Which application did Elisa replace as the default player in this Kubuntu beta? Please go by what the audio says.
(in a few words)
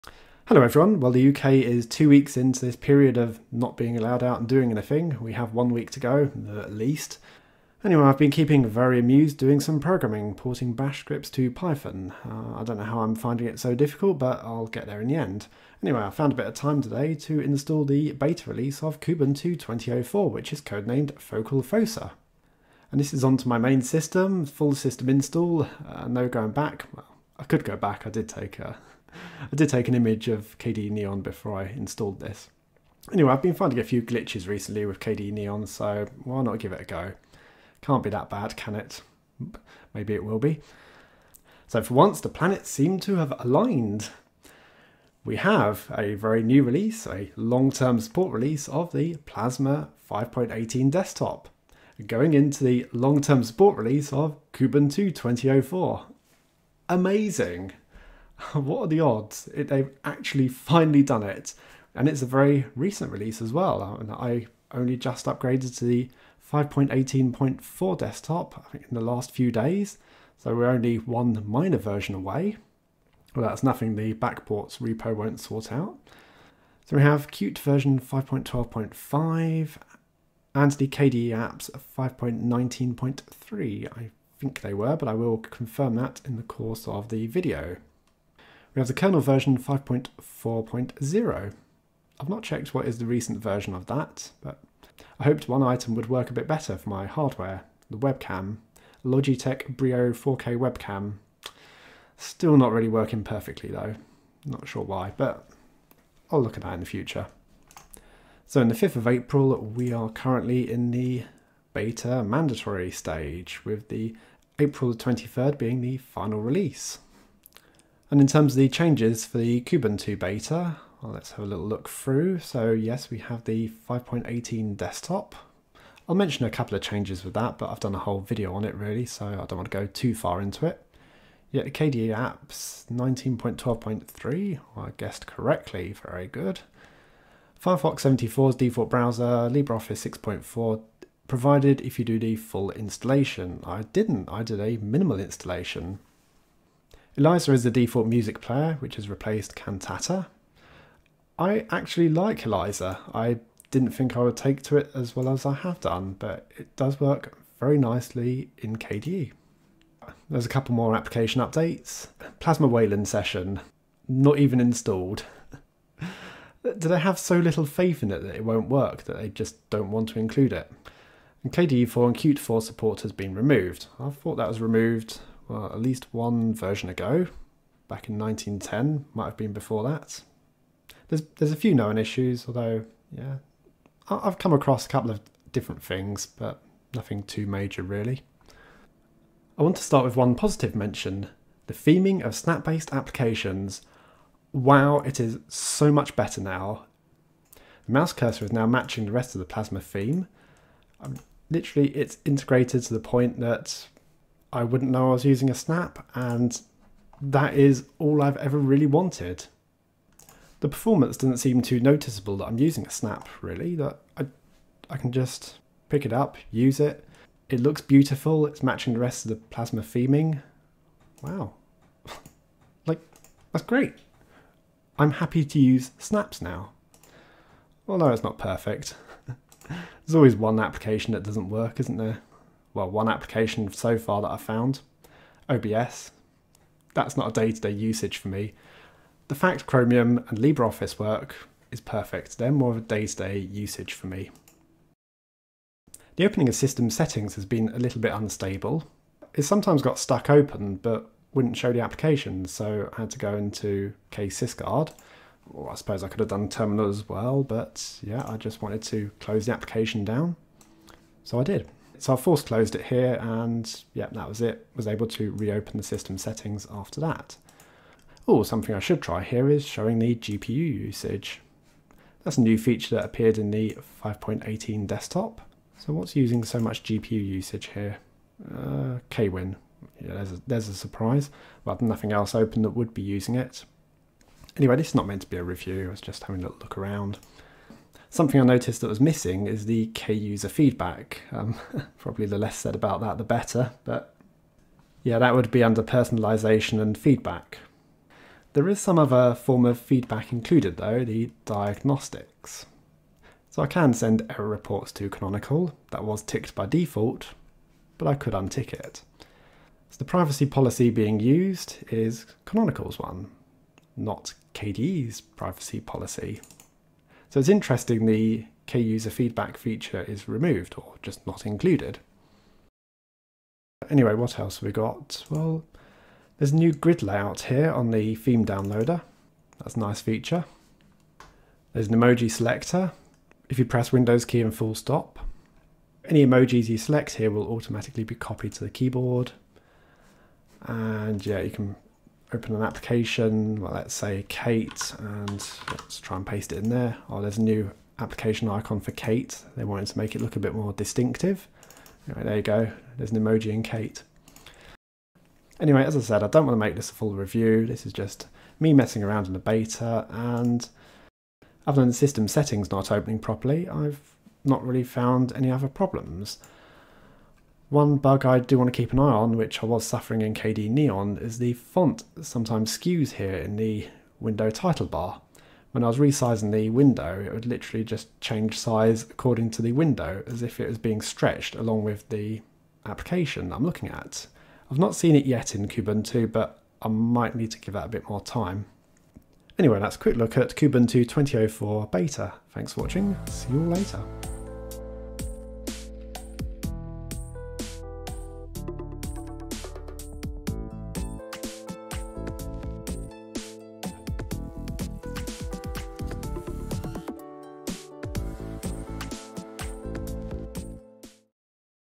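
Cantata.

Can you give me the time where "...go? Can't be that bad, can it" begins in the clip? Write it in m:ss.
0:36.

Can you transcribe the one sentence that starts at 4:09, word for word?
It sometimes got stuck open, but wouldn't show the application, so I had to go into ksysguard.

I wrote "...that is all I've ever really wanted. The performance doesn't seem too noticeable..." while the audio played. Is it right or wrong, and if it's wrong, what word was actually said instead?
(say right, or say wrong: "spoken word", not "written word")
right.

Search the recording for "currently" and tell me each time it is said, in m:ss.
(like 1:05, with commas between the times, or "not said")
1:50.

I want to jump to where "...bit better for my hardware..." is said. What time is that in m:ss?
1:36.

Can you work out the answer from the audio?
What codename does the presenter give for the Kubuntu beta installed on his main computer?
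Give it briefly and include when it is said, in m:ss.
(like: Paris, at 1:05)
Focal Fossa, at 0:21.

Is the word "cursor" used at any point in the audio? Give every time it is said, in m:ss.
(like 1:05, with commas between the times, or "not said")
3:18.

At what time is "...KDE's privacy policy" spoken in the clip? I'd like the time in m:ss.
5:14.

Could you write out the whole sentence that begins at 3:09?
I want to start with one positive mention, the theming of snap-based applications.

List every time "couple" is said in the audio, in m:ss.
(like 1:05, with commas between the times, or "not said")
2:06, 2:40, 3:04.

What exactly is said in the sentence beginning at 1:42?
Still not really working perfectly though, not sure why, but I'll look at that in the future.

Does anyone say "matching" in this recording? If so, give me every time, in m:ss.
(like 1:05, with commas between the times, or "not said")
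3:18, 3:38.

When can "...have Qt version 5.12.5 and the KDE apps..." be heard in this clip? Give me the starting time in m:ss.
1:17.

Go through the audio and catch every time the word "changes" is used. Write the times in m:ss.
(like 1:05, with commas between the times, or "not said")
1:58, 2:06, 6:18.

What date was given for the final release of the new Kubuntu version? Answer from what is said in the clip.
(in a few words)
April 23rd.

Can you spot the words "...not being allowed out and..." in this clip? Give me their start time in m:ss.
0:03.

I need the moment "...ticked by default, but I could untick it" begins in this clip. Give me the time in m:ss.
5:06.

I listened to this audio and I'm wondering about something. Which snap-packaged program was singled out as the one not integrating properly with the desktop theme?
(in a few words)
OBS.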